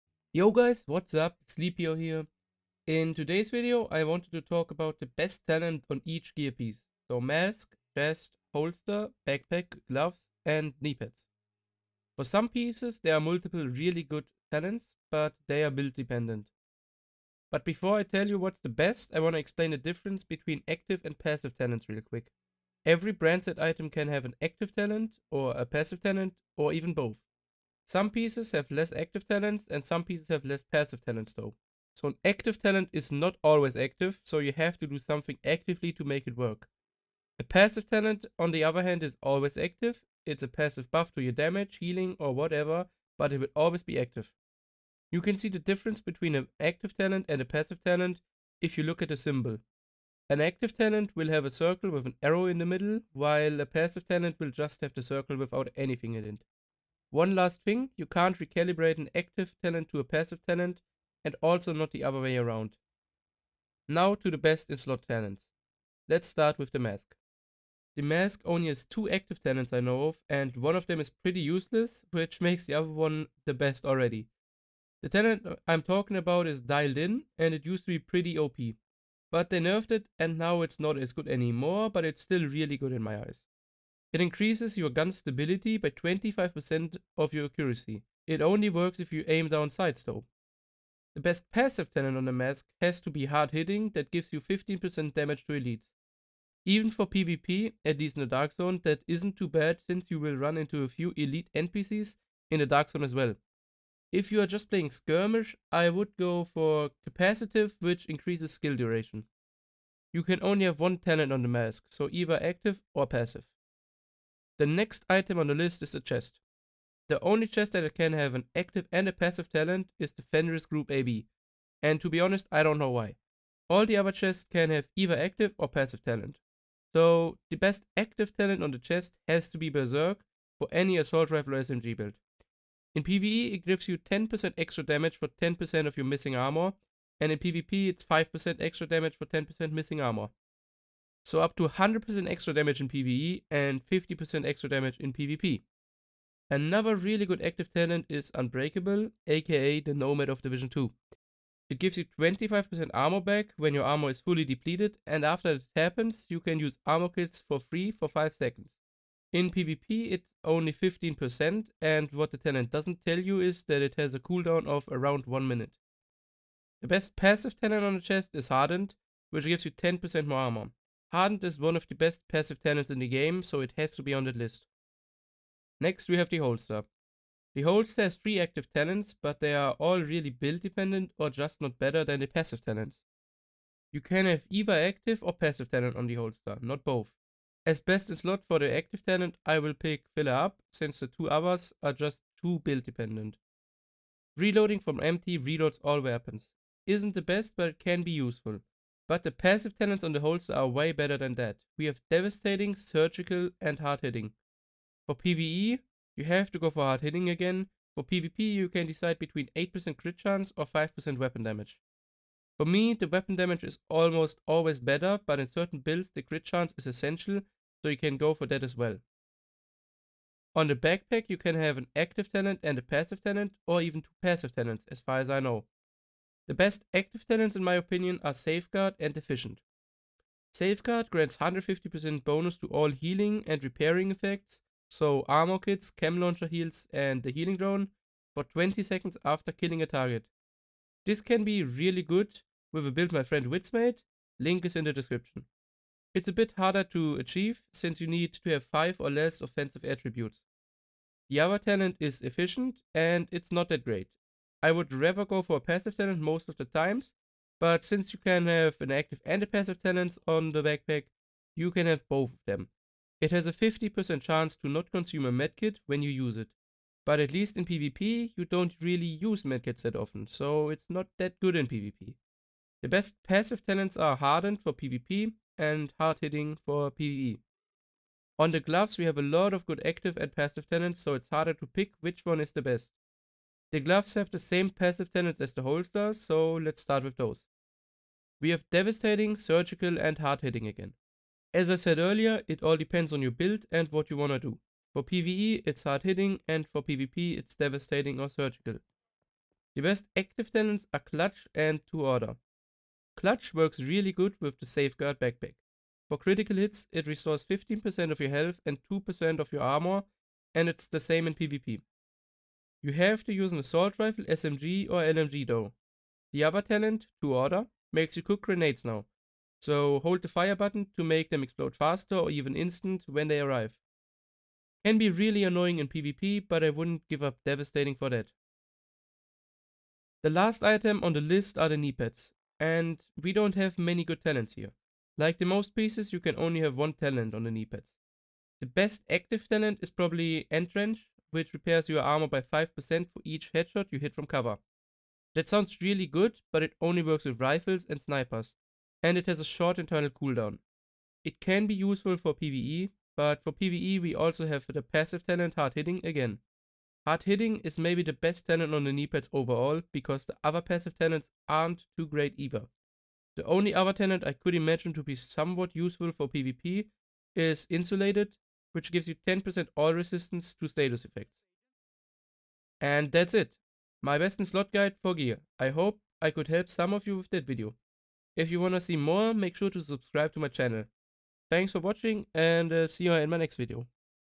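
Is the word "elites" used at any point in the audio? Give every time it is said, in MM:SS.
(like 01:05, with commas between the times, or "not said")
01:35, 01:41.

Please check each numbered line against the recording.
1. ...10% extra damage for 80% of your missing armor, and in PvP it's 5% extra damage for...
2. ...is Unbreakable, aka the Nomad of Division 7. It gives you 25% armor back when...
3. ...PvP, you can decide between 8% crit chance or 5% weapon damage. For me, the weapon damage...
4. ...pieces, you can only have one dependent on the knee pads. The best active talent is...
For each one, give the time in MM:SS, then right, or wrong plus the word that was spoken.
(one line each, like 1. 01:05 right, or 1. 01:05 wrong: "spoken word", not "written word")
1. 02:13 wrong: "10", not "80"
2. 02:28 wrong: "2", not "7"
3. 03:28 right
4. 05:35 wrong: "talent", not "dependent".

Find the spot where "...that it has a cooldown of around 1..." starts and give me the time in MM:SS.
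02:43.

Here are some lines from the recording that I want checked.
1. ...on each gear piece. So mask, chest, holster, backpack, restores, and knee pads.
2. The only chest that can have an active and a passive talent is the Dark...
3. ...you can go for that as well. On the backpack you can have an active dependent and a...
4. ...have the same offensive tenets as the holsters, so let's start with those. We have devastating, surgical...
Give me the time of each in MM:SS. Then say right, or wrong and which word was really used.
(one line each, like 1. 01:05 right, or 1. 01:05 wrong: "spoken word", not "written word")
1. 00:05 wrong: "gloves", not "restores"
2. 01:57 wrong: "Fenris", not "Dark"
3. 03:37 wrong: "talent", not "dependent"
4. 04:44 wrong: "passive", not "offensive".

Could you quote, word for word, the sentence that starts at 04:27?
But at least in PvP, you don't really use medkits that often, so it's not that good in PvP.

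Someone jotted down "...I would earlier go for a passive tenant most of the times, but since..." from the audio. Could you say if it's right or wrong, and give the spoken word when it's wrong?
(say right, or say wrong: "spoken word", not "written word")
wrong: "rather", not "earlier".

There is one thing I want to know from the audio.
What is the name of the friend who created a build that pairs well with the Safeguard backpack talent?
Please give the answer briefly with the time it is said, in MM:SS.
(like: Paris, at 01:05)
widdz, at 04:03.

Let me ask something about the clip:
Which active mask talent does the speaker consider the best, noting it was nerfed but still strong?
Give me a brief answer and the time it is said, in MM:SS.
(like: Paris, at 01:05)
Dialed in, at 01:16.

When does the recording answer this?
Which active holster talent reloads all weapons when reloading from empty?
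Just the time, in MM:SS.
03:10.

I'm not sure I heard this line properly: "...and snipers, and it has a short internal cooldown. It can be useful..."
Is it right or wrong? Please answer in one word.
right.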